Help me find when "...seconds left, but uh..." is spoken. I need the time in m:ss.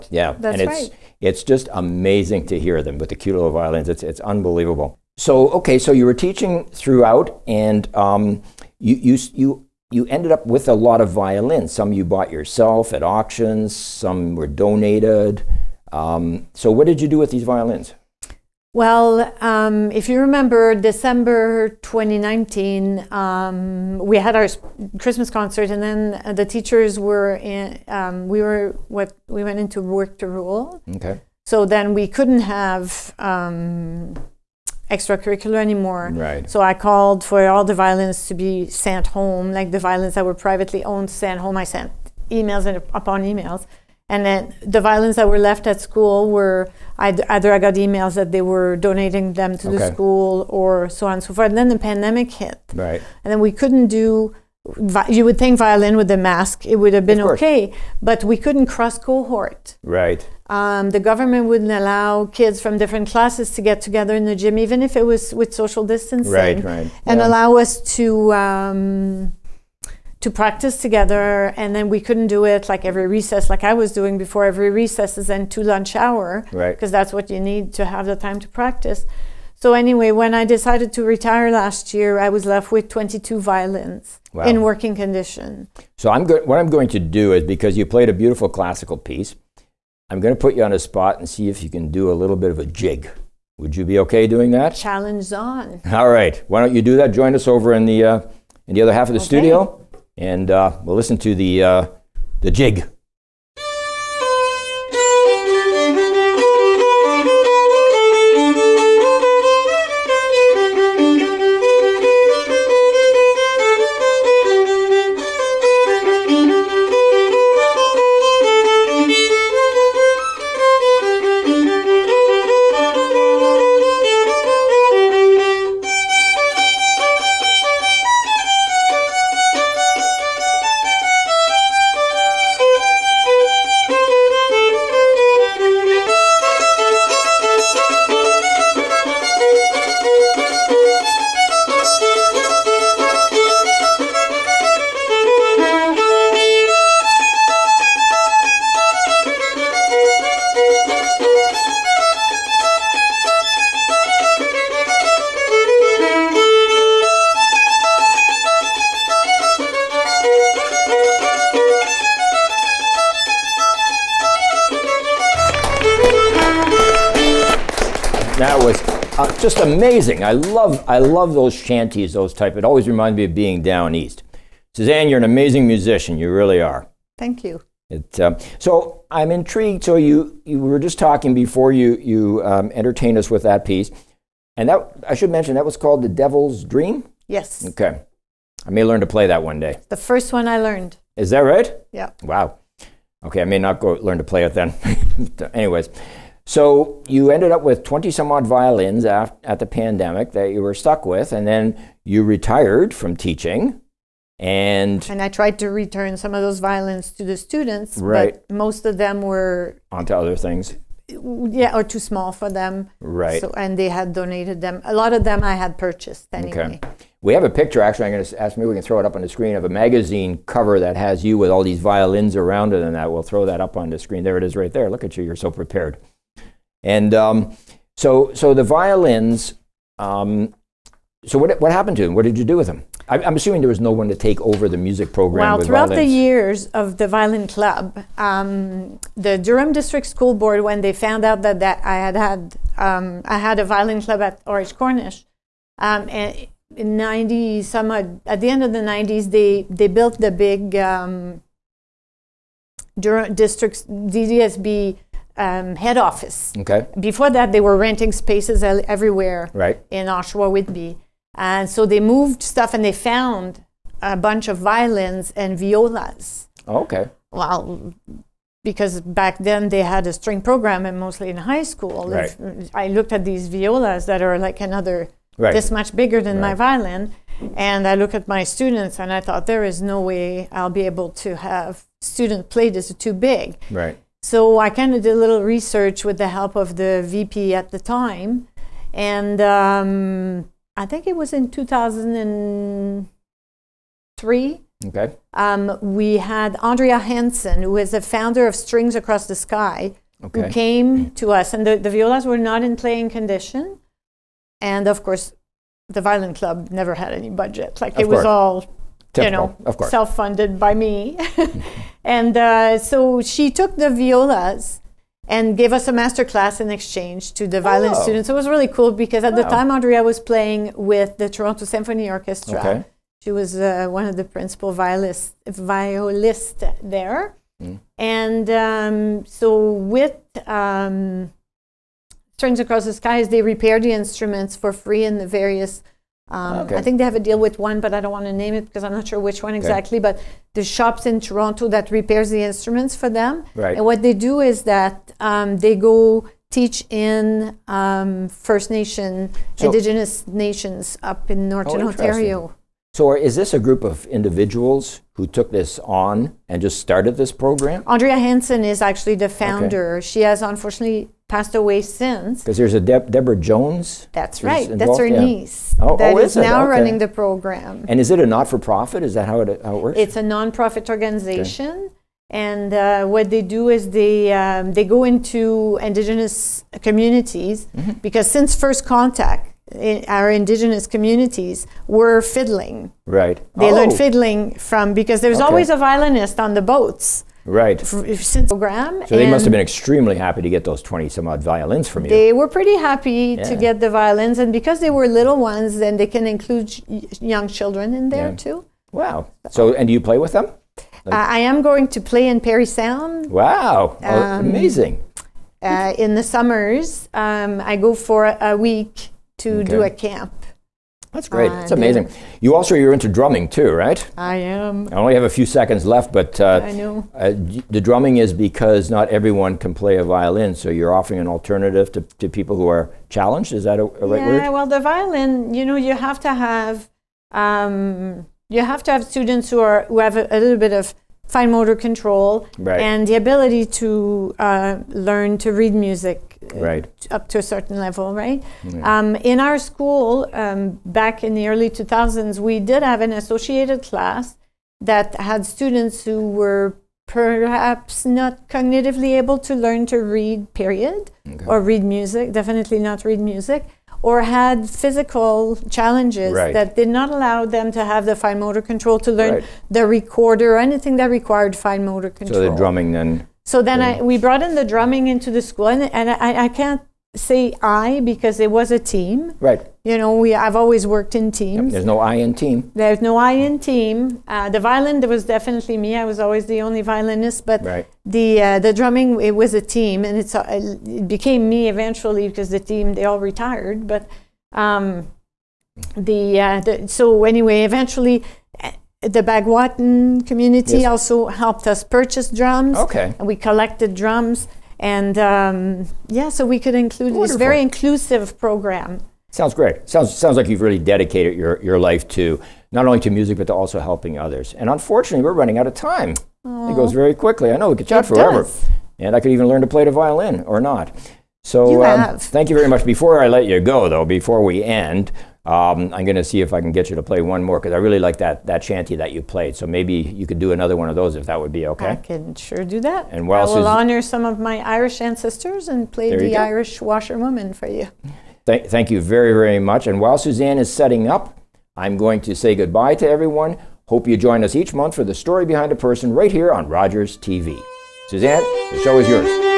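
6:55.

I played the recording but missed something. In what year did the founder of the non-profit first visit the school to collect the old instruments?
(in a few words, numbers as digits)
2003.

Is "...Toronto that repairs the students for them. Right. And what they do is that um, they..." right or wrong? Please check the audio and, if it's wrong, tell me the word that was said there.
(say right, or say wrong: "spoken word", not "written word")
wrong: "instruments", not "students".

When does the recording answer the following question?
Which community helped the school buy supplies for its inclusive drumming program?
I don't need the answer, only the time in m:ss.
8:09.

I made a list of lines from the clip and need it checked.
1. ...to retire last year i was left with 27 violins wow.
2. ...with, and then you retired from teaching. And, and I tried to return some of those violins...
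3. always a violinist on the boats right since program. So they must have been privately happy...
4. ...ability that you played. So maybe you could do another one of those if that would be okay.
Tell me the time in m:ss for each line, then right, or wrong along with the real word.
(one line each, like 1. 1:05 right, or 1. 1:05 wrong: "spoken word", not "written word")
1. 1:20 wrong: "22", not "27"
2. 3:21 right
3. 6:25 wrong: "extremely", not "privately"
4. 8:38 wrong: "shanty", not "ability".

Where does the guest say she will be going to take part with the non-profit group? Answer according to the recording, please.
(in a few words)
Parry Sound.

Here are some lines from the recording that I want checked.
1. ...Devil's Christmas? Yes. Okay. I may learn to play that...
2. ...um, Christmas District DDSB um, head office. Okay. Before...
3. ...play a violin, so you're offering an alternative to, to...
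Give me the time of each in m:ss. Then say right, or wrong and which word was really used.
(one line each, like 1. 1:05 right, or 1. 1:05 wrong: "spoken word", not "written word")
1. 3:06 wrong: "Dream", not "Christmas"
2. 4:10 wrong: "Durham", not "Christmas"
3. 6:59 right.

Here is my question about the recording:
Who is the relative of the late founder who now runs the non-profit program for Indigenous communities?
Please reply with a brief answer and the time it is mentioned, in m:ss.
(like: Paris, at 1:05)
Deborah Jones, at 6:02.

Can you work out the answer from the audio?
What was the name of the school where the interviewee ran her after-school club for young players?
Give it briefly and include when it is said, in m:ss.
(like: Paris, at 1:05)
R.H. Cornish, at 4:04.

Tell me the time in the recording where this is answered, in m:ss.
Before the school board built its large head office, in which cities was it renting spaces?
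4:20.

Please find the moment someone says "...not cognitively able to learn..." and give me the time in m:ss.
7:28.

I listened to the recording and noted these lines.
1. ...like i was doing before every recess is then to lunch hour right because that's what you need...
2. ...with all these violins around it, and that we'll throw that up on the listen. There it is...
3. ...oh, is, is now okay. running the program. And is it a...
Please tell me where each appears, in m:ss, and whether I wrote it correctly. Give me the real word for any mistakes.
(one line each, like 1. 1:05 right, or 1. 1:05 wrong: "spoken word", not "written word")
1. 1:13 right
2. 3:41 wrong: "screen", not "listen"
3. 6:06 right.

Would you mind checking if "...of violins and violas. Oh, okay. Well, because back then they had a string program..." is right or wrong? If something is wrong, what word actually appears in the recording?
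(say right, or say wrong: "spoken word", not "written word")
right.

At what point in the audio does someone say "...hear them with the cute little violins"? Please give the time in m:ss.
0:02.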